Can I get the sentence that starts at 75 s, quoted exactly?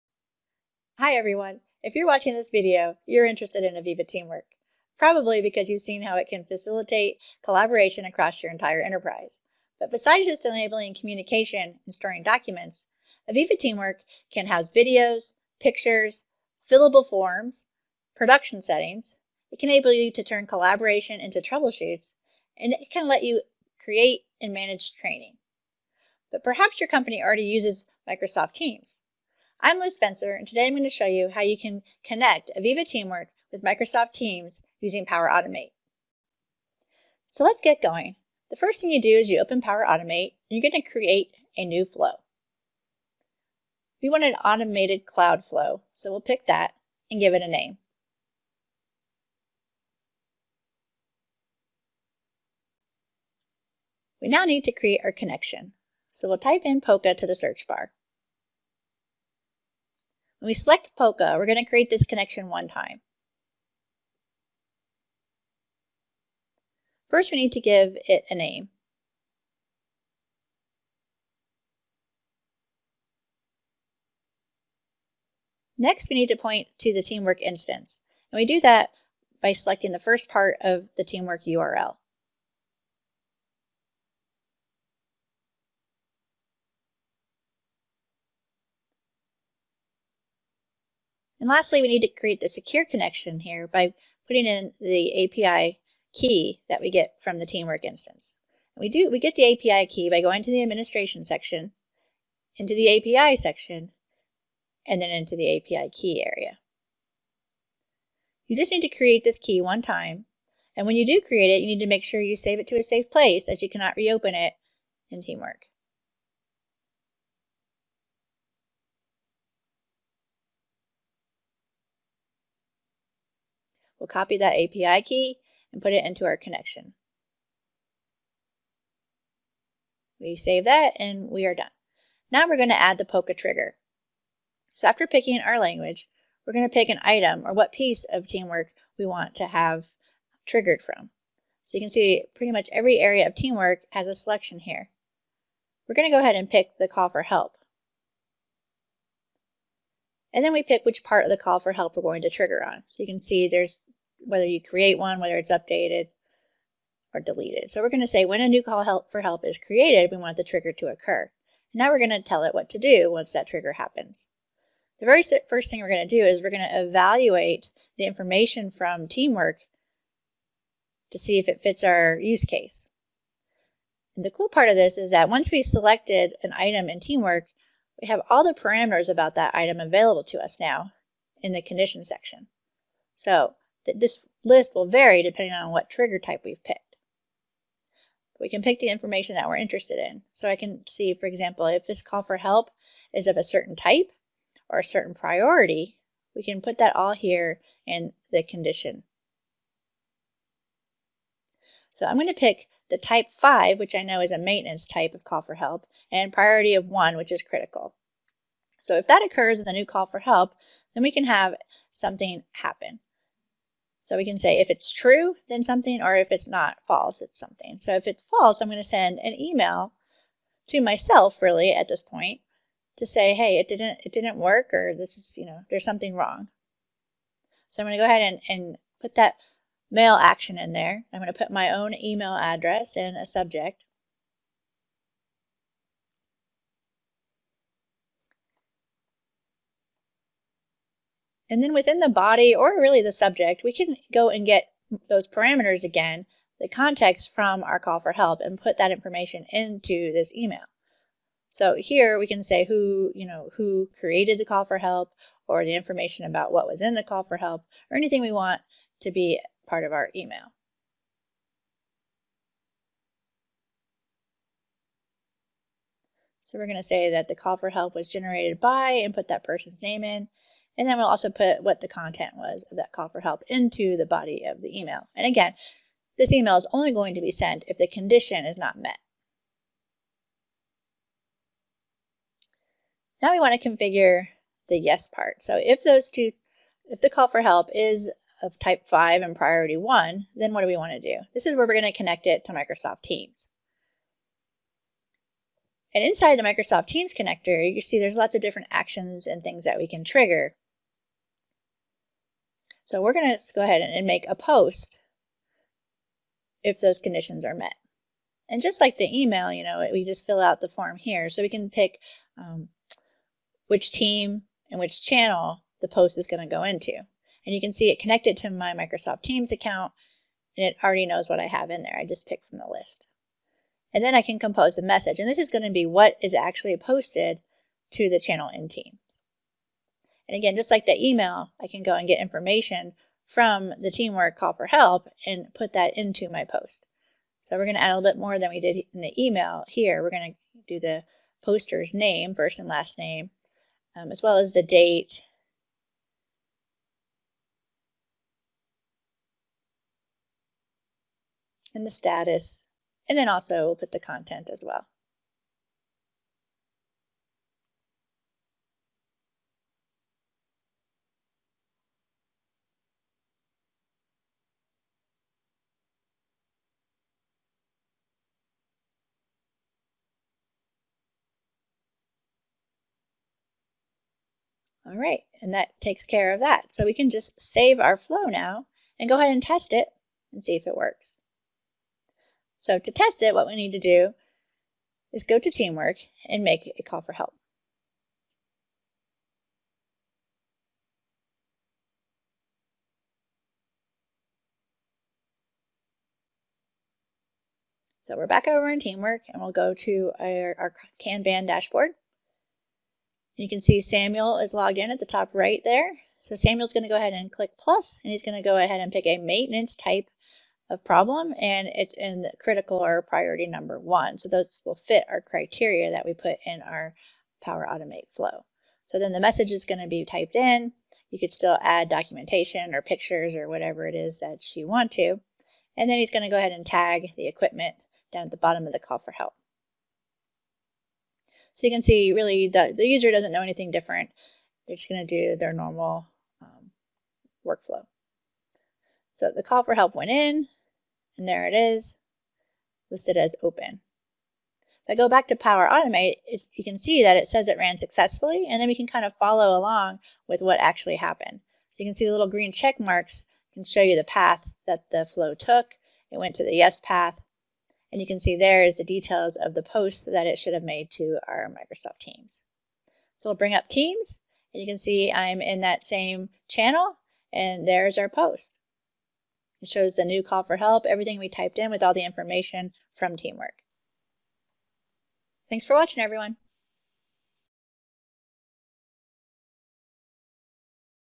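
Next, we need to point to the Teamwork instance.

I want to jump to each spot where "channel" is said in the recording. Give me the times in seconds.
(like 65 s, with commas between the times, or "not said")
315 s, 328 s, 466 s.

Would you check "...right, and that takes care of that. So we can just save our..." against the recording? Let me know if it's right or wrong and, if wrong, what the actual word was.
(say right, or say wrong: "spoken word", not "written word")
right.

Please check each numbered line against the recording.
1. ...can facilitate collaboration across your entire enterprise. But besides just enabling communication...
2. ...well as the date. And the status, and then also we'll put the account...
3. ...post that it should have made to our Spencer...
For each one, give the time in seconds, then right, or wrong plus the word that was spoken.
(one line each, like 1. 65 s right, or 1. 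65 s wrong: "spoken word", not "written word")
1. 6 s right
2. 344 s wrong: "content", not "account"
3. 459 s wrong: "Microsoft", not "Spencer".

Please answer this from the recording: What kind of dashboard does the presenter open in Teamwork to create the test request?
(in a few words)
Kanban.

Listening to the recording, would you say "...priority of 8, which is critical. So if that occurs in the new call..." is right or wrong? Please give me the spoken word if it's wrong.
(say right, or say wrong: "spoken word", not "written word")
wrong: "1", not "8".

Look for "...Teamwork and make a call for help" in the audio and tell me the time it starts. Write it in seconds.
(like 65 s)
385 s.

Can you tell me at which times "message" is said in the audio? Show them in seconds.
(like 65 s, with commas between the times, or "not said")
324 s, 419 s.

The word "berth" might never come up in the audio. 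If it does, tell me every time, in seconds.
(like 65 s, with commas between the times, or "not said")
not said.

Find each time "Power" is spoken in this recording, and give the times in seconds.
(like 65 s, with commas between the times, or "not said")
35 s, 39 s, 417 s, 445 s.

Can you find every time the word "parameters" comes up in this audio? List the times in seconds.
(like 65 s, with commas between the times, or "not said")
178 s, 245 s.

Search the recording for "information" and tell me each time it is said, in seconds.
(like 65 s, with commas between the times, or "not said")
168 s, 188 s, 248 s, 255 s, 332 s, 472 s.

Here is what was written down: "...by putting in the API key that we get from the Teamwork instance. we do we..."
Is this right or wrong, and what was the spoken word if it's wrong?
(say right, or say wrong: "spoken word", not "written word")
right.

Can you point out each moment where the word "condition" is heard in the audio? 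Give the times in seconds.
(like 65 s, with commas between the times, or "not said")
181 s, 198 s, 277 s, 306 s.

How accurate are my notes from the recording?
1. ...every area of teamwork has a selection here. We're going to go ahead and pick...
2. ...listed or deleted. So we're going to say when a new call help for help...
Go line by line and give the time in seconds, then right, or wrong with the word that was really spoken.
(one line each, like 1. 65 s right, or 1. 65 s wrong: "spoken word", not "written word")
1. 142 s right
2. 155 s wrong: "updated", not "listed".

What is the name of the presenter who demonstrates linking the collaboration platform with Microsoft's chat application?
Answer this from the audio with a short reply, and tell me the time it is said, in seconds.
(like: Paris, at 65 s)
Liz Spencer, at 29 s.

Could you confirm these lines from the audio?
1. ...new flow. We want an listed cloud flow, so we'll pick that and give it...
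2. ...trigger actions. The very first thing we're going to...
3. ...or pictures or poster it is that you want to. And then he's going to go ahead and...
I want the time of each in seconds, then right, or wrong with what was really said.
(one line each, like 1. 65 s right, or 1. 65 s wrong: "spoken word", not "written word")
1. 41 s wrong: "automated", not "listed"
2. 163 s wrong: "happens", not "actions"
3. 422 s wrong: "whatever", not "poster".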